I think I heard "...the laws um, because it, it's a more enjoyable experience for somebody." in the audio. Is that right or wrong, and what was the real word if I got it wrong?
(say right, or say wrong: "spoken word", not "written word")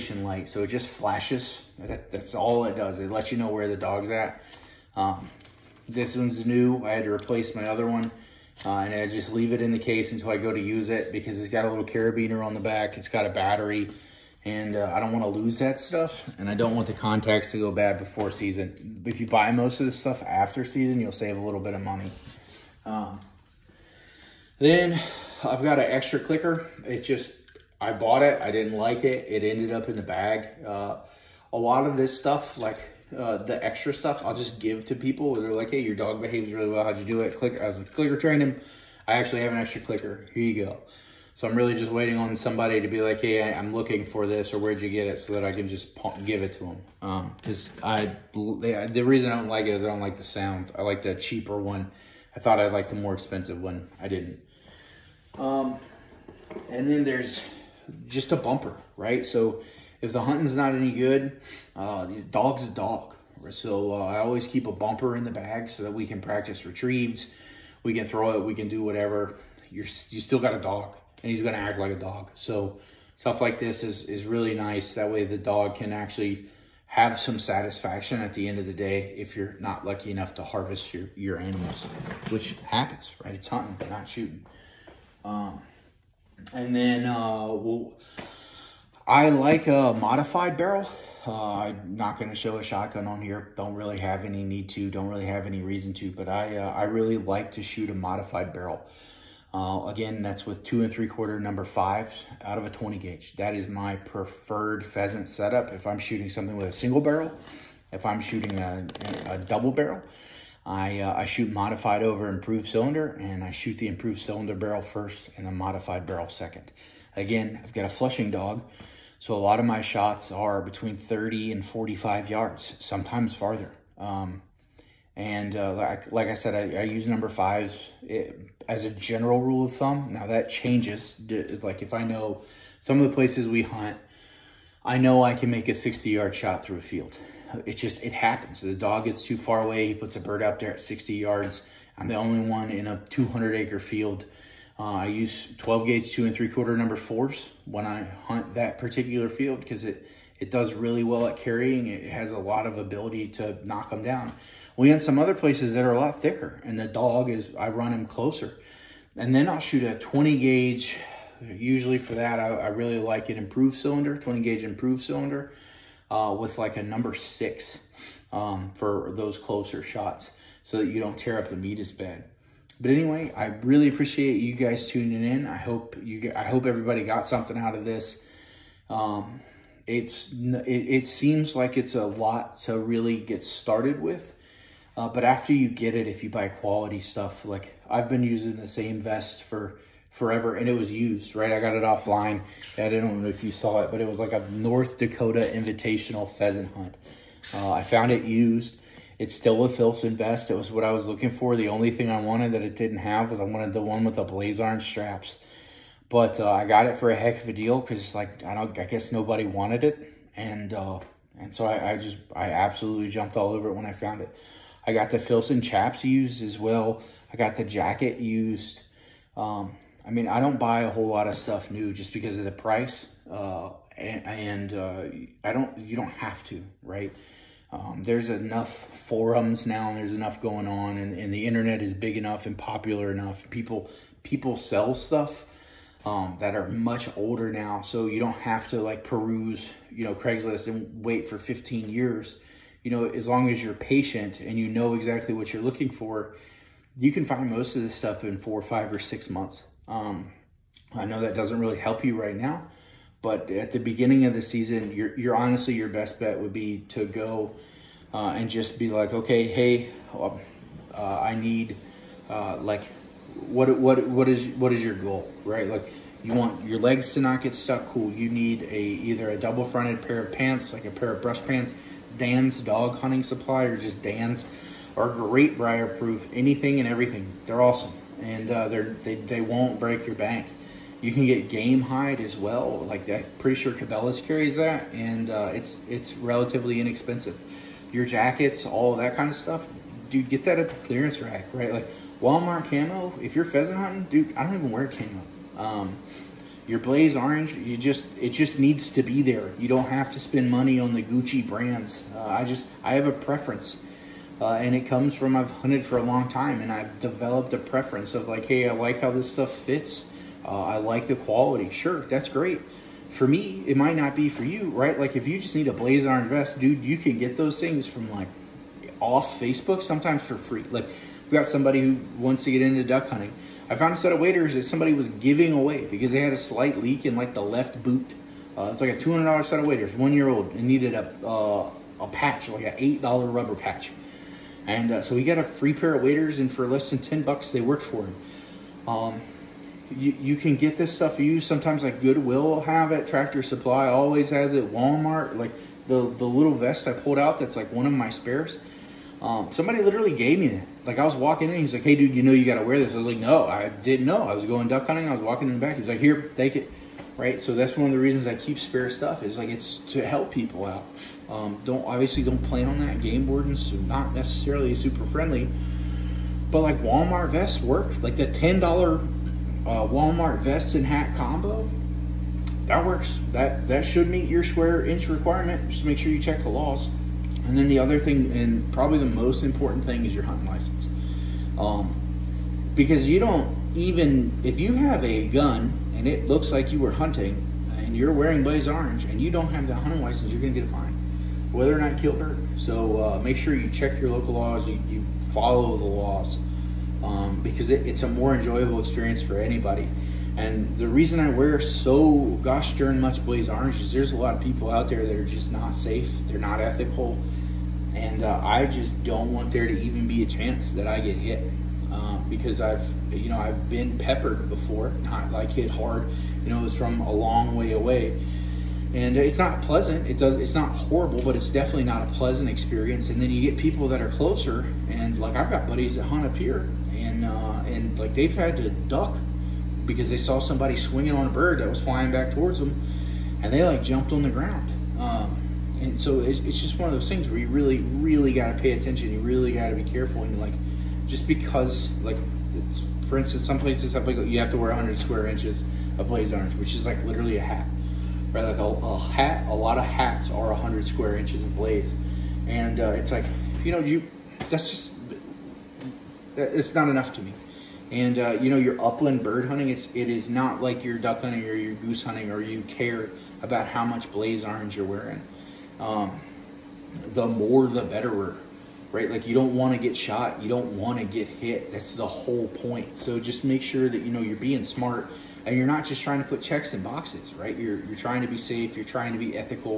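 wrong: "anybody", not "somebody".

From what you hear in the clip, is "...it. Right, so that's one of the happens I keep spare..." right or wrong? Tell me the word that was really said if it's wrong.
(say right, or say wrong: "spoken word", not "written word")
wrong: "reasons", not "happens".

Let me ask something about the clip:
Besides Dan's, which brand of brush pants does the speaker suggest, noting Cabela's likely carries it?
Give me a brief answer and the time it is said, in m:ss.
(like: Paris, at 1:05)
Gamehide, at 4:41.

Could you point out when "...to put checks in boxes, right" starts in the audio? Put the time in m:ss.
7:56.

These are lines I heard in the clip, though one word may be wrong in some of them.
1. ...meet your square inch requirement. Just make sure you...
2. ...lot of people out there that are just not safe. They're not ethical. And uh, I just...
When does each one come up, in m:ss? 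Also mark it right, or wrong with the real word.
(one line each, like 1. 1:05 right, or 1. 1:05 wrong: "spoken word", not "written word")
1. 6:14 right
2. 6:44 right.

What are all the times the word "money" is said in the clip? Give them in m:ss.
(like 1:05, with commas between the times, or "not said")
0:21, 5:00.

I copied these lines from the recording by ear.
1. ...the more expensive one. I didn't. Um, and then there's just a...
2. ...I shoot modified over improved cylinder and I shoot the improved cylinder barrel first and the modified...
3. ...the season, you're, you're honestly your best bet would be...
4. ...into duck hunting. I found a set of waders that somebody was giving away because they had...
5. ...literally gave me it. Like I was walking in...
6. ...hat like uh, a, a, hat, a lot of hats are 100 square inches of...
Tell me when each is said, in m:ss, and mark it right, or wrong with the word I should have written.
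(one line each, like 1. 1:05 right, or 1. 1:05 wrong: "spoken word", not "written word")
1. 0:52 right
2. 1:51 right
3. 4:14 right
4. 5:22 right
5. 5:49 right
6. 7:27 right.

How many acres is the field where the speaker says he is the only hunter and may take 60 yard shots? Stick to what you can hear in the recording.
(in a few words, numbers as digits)
200.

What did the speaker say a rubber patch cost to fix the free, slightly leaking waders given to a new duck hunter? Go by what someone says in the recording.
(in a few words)
$8.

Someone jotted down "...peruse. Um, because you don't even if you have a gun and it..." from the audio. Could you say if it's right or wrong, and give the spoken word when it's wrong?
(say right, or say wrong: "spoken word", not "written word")
wrong: "license", not "peruse".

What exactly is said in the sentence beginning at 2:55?
I hope you get, I hope everybody got something out of this.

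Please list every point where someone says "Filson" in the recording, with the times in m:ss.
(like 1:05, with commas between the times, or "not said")
3:19, 3:35.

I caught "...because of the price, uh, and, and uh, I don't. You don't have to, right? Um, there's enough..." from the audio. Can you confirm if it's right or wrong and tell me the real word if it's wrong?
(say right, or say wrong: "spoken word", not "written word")
right.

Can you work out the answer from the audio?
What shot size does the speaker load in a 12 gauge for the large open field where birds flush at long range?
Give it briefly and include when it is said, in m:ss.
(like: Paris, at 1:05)
number 4, at 2:26.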